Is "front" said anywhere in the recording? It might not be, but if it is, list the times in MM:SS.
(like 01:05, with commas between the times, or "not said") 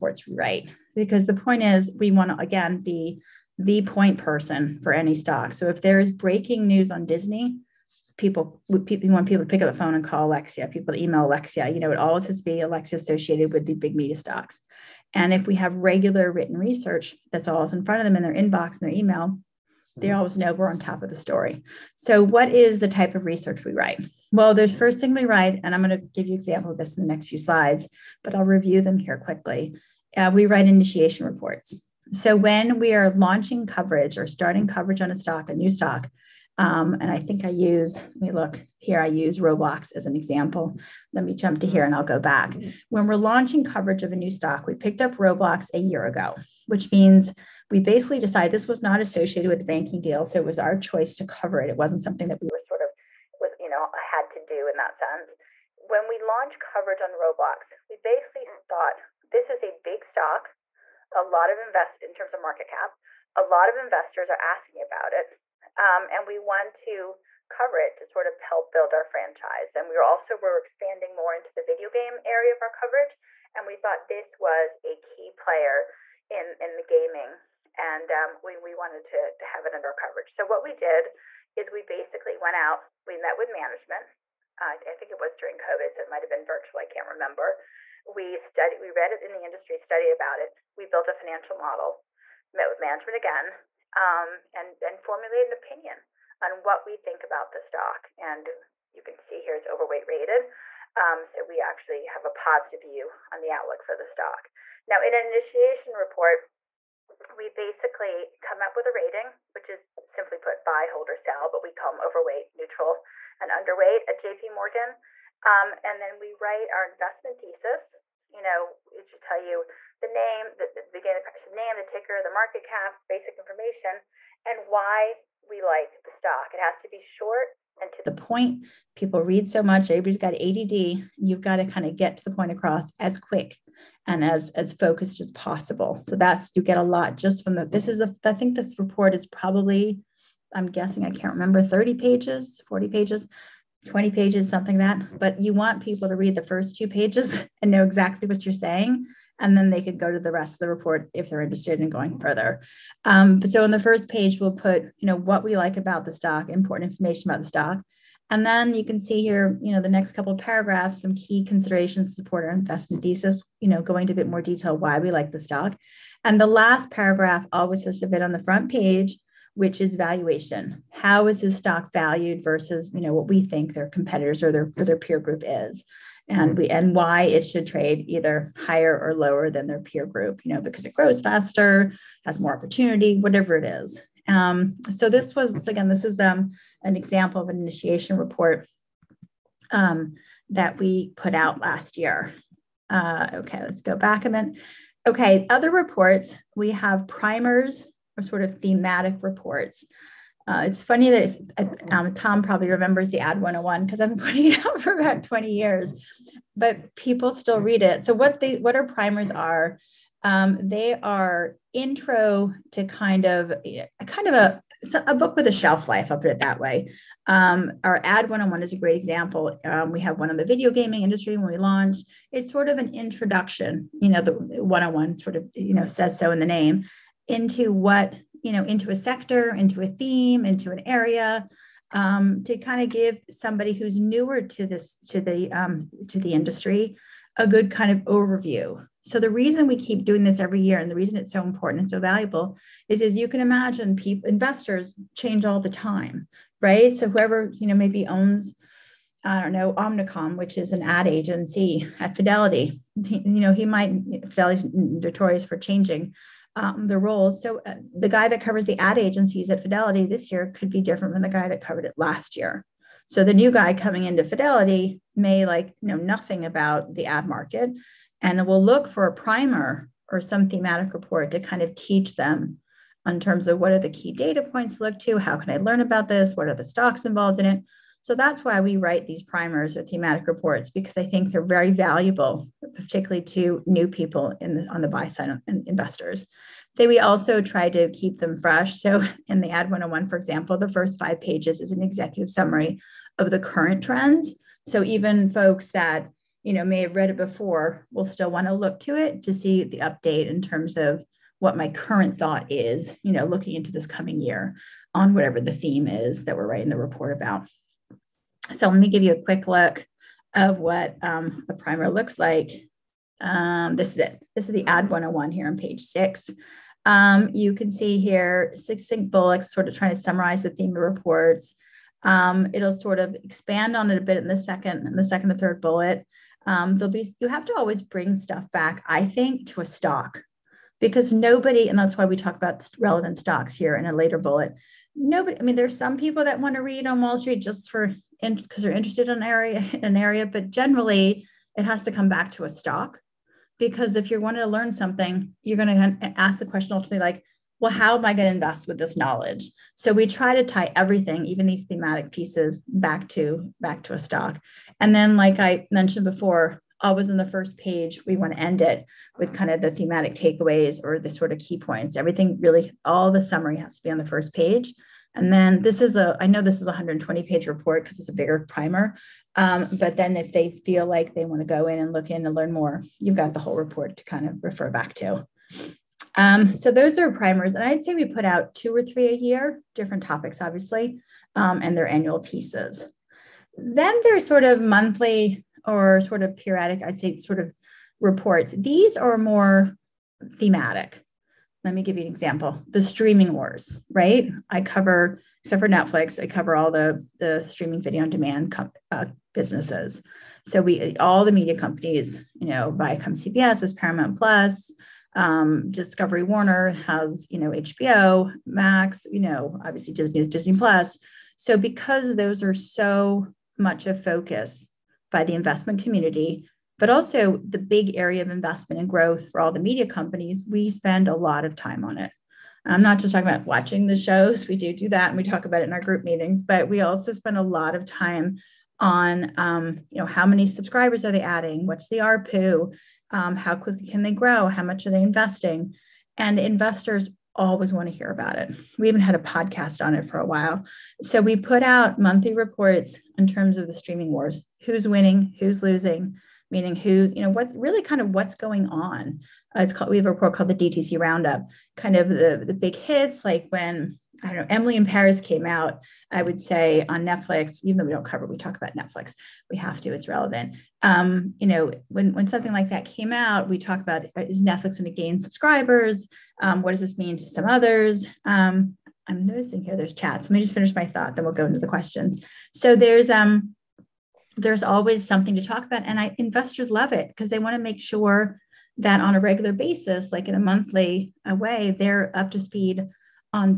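00:17, 02:48.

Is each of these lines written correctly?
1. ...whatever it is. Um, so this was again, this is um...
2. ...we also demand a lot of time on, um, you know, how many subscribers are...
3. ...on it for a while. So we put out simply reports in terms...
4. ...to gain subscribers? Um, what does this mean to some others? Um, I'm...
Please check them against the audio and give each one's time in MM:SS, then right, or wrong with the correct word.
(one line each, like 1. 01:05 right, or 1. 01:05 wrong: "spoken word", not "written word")
1. 03:03 right
2. 07:06 wrong: "spend", not "demand"
3. 07:19 wrong: "monthly", not "simply"
4. 07:44 right.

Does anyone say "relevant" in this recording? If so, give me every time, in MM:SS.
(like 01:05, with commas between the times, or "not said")
05:32, 07:40.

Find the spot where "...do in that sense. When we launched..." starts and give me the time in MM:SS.
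00:54.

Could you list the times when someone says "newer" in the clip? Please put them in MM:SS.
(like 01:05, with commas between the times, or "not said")
03:53.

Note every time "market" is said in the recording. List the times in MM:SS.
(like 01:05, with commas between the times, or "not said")
01:02, 02:02, 04:27.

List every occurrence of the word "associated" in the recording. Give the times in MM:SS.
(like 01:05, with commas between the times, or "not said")
00:12, 00:48.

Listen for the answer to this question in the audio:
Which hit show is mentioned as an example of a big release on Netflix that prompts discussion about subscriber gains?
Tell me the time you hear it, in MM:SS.
07:34.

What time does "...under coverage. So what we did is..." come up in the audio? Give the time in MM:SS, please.
01:19.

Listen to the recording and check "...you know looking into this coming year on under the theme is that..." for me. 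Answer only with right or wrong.
wrong.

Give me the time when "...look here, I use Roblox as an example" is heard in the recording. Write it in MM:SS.
00:38.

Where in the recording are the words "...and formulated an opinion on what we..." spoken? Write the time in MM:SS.
01:34.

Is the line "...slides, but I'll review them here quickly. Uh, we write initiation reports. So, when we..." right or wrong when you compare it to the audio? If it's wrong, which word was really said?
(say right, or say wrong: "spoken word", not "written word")
right.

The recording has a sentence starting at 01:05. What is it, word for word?
Um, and we want to cover it to sort of help build our franchise.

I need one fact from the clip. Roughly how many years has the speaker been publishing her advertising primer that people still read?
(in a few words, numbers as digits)
20.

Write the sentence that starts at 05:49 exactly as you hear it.
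So we try to tie everything, even these thematic pieces, back to back to a stock.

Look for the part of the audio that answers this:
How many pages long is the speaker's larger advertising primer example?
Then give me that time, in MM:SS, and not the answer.
06:06.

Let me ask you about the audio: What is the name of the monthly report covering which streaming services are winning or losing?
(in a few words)
DTC Roundup.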